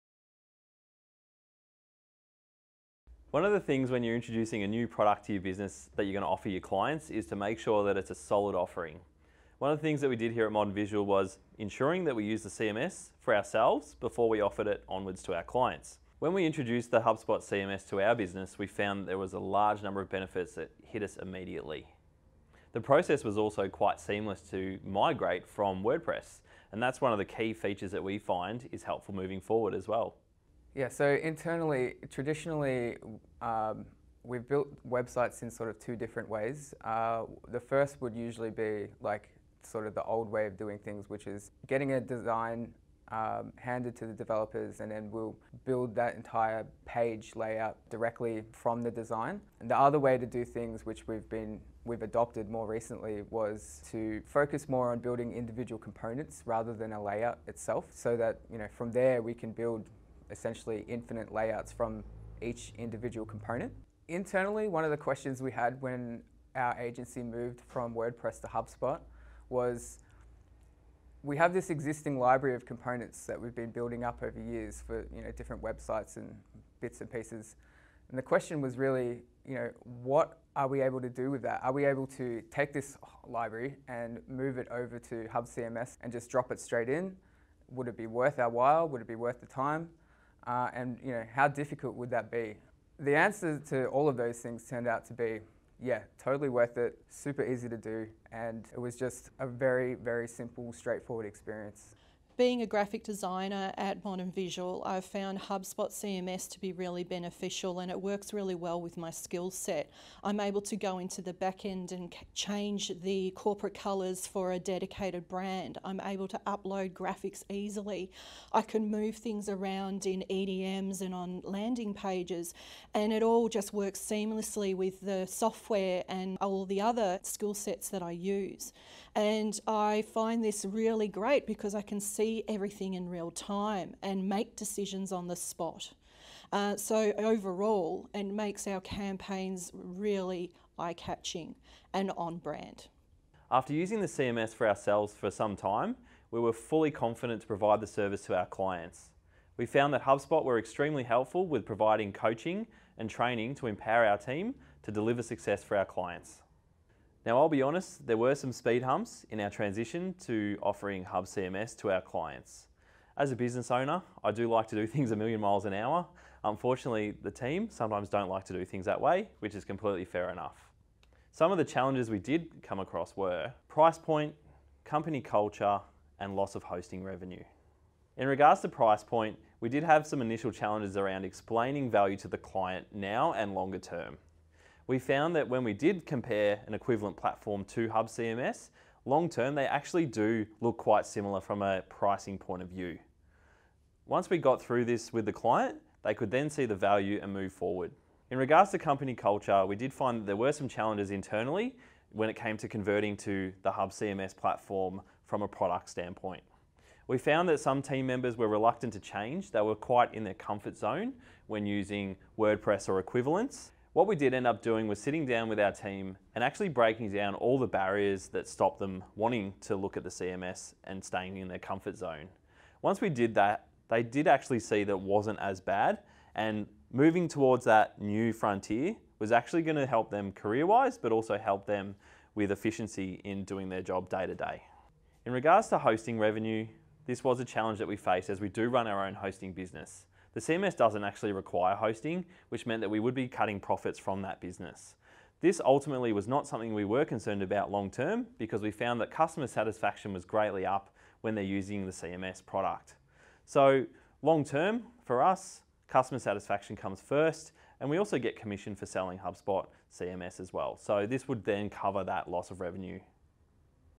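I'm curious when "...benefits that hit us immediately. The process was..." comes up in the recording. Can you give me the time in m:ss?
0:20.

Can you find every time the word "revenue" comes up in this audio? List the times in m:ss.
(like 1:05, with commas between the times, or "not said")
2:57, 3:56, 4:22.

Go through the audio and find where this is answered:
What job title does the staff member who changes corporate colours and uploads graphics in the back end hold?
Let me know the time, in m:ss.
1:42.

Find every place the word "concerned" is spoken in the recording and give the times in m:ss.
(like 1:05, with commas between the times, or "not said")
4:07.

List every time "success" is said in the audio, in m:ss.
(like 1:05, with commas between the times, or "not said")
2:35.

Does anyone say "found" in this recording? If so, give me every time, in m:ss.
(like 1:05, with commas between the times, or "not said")
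0:18, 1:45, 2:29, 3:04, 3:27, 4:08.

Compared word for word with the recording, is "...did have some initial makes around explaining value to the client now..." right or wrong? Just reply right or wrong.
wrong.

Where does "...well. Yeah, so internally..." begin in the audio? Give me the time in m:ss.
0:29.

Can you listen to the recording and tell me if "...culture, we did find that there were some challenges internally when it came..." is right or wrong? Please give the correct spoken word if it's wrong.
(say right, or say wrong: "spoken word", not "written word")
right.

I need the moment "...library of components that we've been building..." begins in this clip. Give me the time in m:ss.
1:12.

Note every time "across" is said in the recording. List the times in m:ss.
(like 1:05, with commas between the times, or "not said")
2:52.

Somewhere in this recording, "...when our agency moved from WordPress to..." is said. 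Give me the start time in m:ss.
1:05.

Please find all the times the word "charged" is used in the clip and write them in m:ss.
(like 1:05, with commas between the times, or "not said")
not said.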